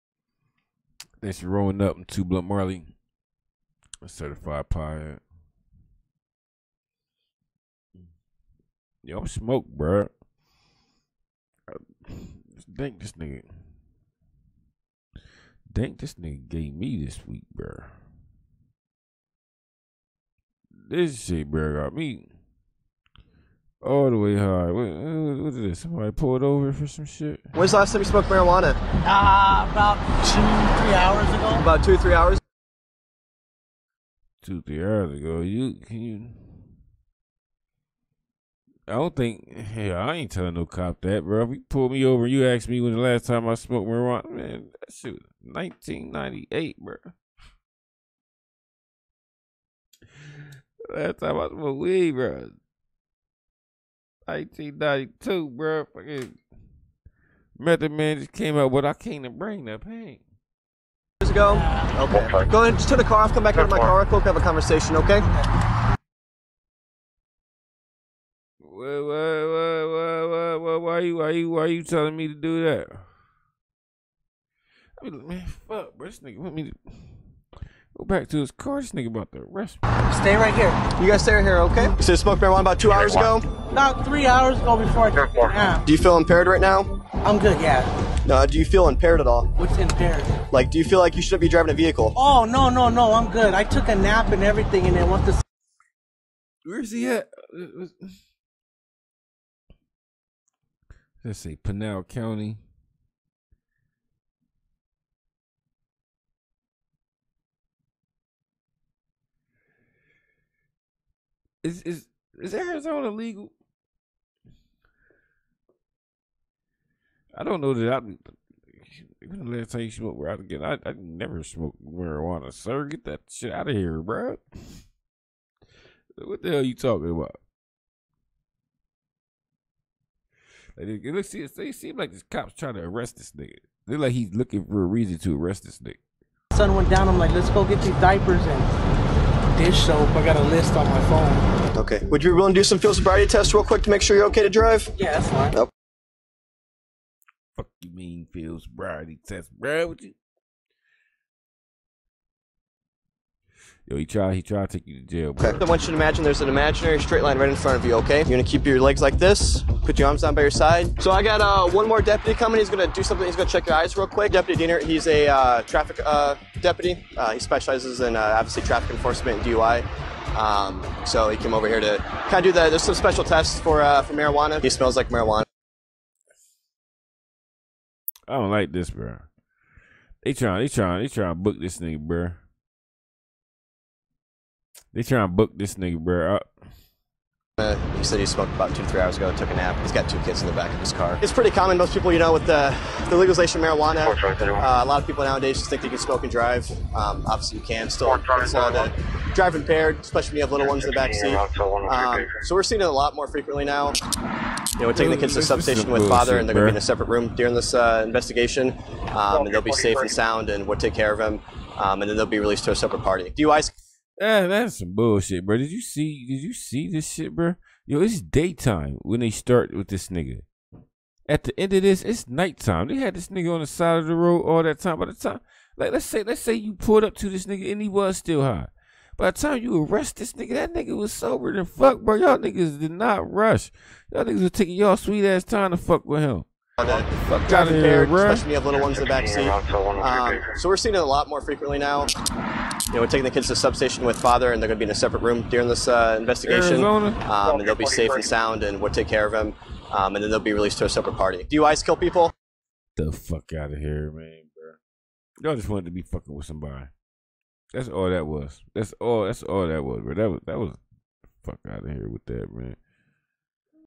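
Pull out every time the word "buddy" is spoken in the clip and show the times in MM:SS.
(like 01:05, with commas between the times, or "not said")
not said.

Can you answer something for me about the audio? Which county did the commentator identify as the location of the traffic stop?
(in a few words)
Pinal County.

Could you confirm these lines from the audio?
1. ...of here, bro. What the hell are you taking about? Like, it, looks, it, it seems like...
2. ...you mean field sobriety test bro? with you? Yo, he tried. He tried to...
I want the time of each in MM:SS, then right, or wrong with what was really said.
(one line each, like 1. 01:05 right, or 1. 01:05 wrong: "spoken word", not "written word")
1. 02:03 wrong: "talking", not "taking"
2. 02:27 right.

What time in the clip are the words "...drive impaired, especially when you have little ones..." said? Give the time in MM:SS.
03:19.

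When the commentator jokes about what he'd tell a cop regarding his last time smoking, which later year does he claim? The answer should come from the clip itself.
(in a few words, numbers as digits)
1992.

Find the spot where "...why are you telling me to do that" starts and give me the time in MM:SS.
01:11.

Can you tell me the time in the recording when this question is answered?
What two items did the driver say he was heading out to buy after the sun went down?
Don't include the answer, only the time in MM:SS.
02:17.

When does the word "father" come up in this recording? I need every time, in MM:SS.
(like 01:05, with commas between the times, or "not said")
03:26, 04:04.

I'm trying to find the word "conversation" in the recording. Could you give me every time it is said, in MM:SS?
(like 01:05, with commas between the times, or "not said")
01:04.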